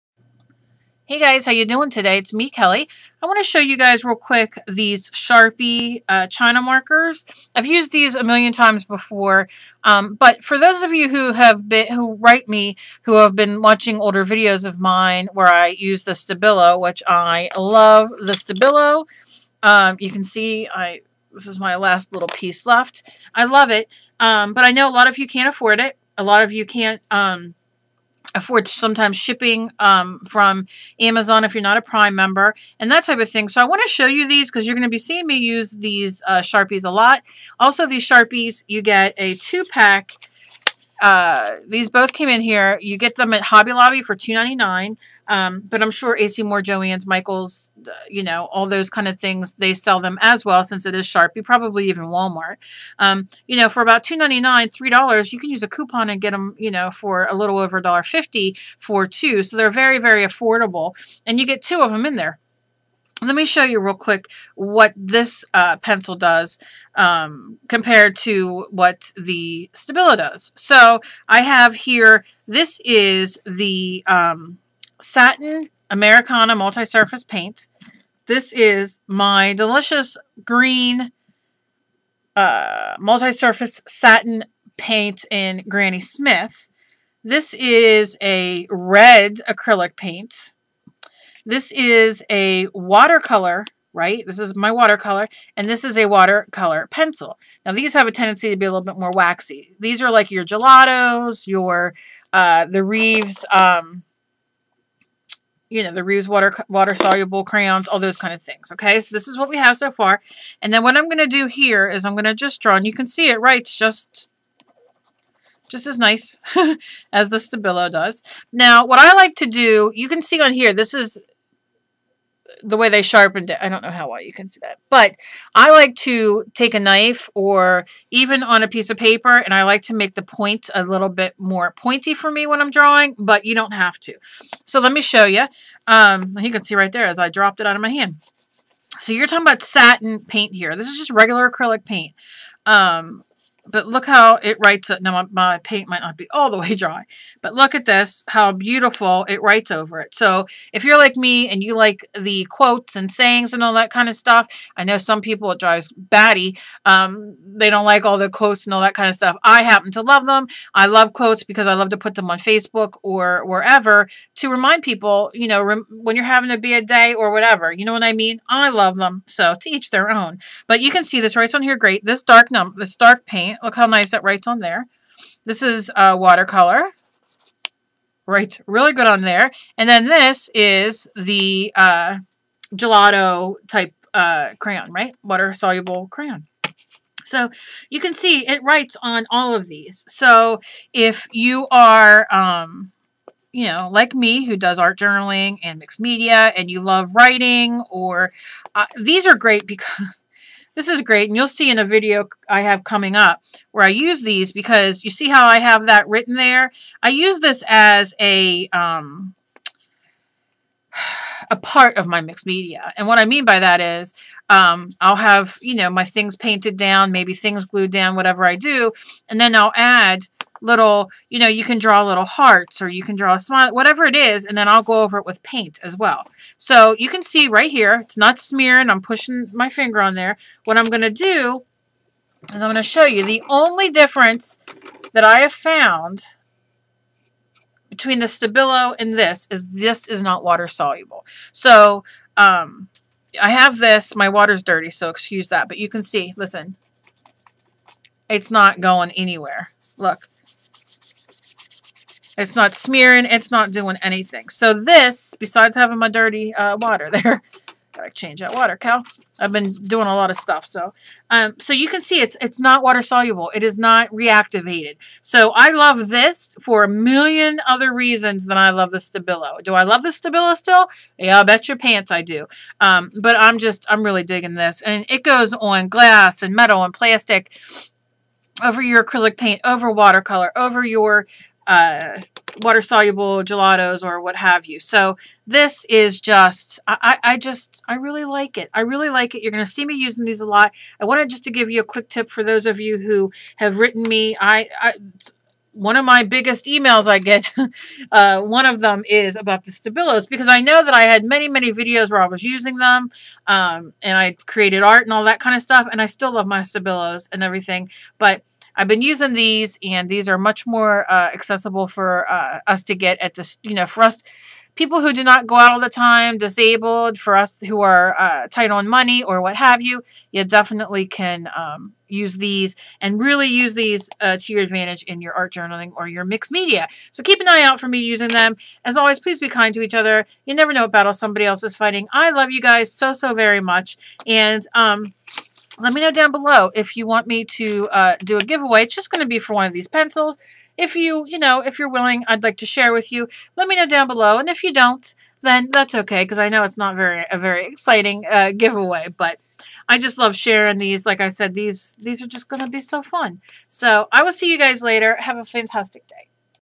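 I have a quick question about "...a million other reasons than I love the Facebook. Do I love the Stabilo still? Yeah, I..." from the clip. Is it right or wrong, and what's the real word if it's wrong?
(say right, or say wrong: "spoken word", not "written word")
wrong: "Stabilo", not "Facebook".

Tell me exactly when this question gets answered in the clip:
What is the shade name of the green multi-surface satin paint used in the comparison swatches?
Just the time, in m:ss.
1:25.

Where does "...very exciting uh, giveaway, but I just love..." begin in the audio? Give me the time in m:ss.
5:47.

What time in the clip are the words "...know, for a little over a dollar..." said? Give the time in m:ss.
0:56.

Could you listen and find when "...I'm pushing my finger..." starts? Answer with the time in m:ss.
3:48.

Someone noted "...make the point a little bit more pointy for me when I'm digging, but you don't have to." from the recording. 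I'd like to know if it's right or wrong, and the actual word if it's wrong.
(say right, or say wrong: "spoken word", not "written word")
wrong: "drawing", not "digging".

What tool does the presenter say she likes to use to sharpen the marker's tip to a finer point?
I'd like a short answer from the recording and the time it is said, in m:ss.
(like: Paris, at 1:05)
a knife, at 2:06.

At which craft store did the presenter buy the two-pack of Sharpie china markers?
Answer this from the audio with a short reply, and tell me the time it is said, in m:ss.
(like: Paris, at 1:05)
Hobby Lobby, at 0:43.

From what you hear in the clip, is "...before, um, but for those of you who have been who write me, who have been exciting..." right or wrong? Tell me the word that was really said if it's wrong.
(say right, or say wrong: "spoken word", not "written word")
wrong: "watching", not "exciting".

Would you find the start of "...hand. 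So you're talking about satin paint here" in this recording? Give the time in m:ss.
2:17.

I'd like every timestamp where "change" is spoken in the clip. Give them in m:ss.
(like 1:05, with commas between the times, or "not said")
4:18.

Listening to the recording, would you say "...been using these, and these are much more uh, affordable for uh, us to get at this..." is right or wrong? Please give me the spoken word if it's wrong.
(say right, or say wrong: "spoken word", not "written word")
wrong: "accessible", not "affordable".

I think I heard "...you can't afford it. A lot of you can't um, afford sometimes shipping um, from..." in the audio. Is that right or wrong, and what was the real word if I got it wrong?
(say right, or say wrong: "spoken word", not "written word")
right.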